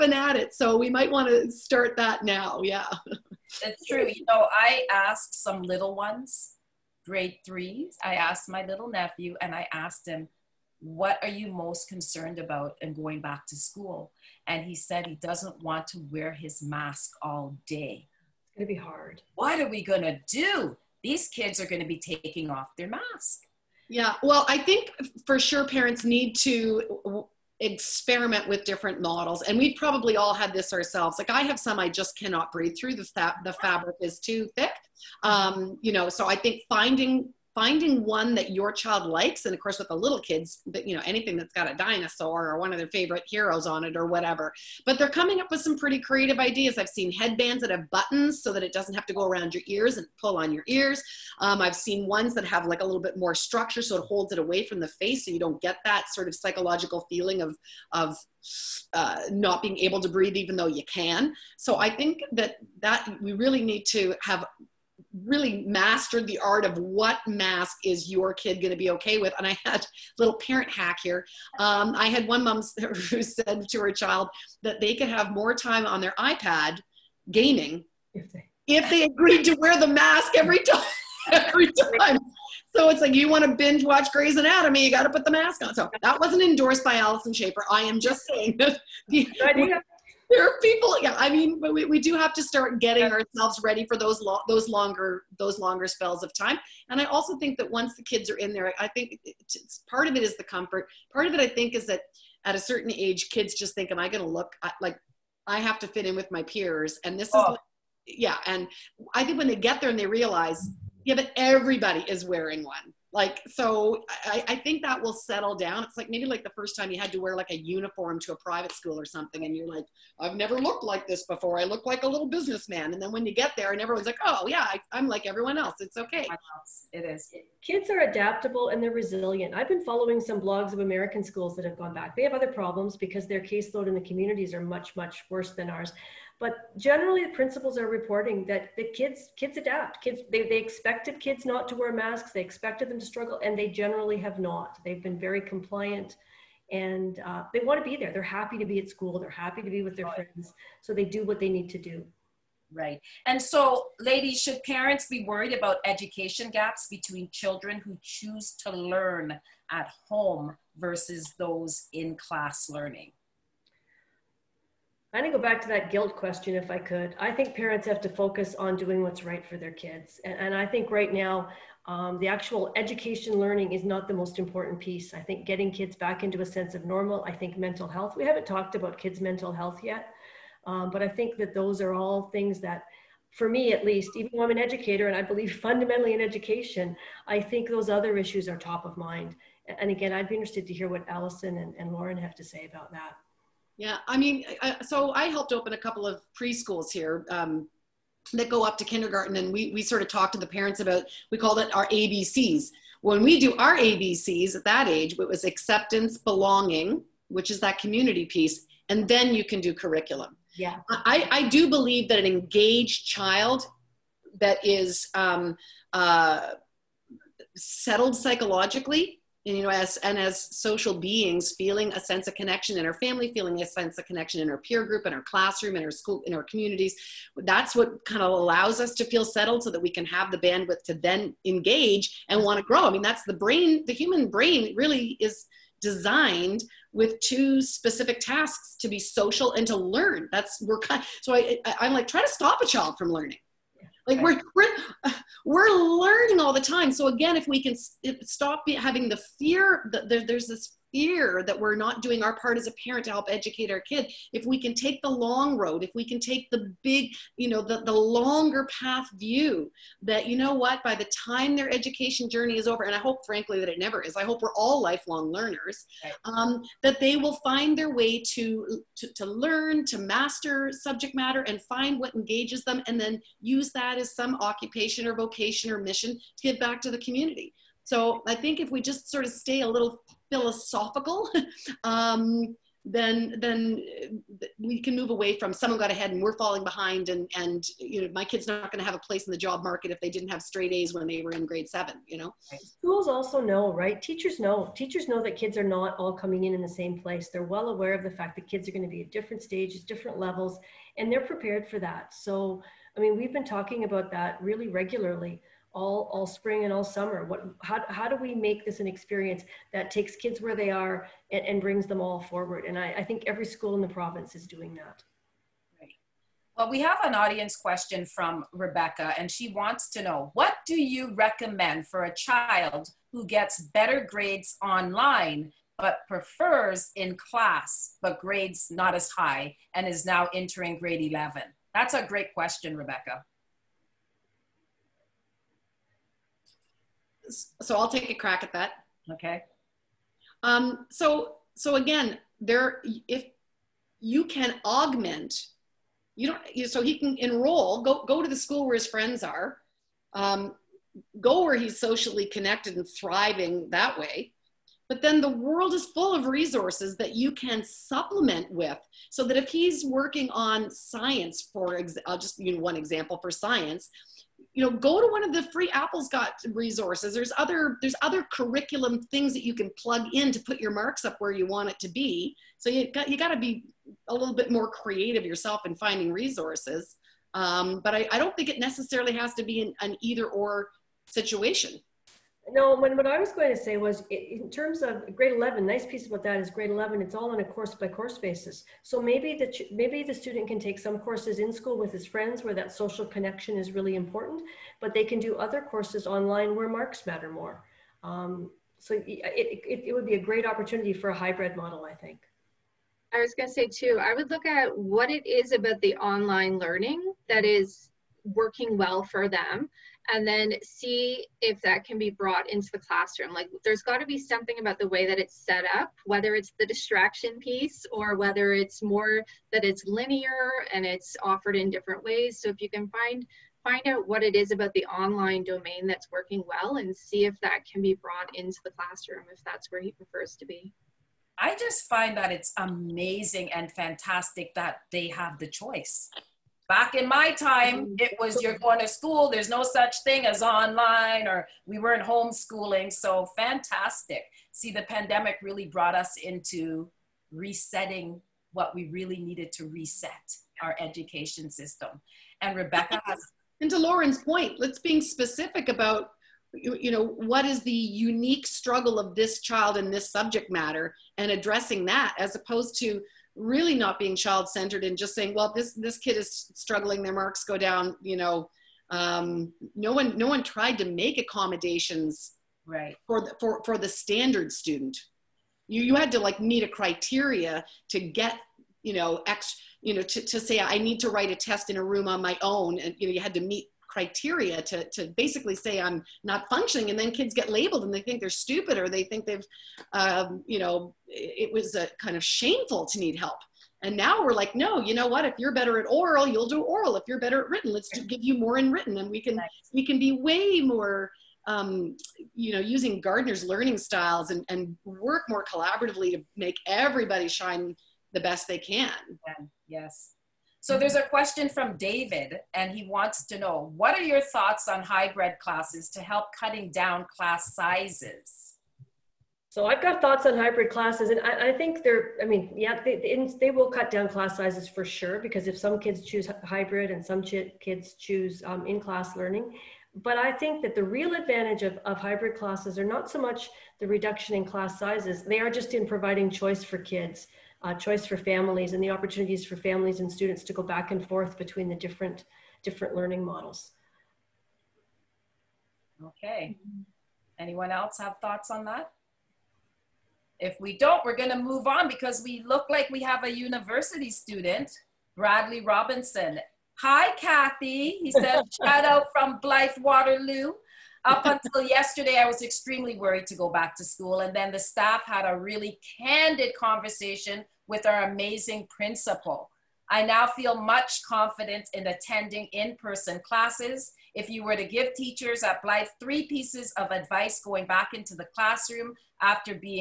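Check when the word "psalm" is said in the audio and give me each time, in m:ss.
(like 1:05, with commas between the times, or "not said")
not said.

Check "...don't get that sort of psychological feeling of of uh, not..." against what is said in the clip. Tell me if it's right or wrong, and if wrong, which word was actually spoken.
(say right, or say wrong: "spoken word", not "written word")
right.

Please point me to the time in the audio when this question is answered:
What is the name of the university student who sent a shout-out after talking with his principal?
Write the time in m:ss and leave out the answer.
9:15.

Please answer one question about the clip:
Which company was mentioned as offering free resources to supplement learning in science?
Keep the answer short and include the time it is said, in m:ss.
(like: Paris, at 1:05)
Apple, at 6:05.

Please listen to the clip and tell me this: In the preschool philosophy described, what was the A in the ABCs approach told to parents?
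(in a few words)
acceptance.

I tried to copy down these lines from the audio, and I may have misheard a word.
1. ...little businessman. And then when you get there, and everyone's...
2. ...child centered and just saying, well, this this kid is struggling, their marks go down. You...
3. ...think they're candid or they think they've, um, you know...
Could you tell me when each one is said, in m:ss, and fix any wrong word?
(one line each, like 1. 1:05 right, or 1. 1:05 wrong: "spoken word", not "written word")
1. 2:02 right
2. 7:44 right
3. 8:08 wrong: "stupid", not "candid".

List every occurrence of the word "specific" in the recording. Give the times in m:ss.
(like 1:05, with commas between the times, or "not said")
3:57, 7:35.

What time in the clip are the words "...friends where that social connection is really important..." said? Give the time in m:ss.
6:32.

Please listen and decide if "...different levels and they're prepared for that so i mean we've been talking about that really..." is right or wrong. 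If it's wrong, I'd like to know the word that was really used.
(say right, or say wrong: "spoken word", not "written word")
right.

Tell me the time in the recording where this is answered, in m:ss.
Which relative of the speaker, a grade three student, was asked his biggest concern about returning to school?
0:08.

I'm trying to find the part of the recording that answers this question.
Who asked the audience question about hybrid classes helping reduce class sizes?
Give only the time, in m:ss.
8:31.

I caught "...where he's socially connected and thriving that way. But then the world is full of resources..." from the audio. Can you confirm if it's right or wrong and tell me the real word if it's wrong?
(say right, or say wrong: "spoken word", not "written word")
right.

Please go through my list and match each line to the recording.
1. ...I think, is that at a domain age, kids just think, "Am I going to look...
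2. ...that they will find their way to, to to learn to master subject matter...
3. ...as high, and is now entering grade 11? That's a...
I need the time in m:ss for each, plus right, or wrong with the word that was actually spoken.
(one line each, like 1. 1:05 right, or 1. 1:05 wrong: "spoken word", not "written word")
1. 1:41 wrong: "certain", not "domain"
2. 4:26 right
3. 5:28 right.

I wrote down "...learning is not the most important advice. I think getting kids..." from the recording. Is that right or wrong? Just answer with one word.
wrong.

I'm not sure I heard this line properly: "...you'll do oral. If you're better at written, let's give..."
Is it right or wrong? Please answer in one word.
right.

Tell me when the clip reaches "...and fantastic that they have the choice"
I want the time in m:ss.
7:13.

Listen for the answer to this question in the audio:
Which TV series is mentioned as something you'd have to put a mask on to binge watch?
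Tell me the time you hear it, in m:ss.
1:24.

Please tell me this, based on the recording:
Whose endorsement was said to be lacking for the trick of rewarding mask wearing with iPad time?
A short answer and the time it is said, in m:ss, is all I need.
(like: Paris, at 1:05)
Alyson Schafer, at 1:26.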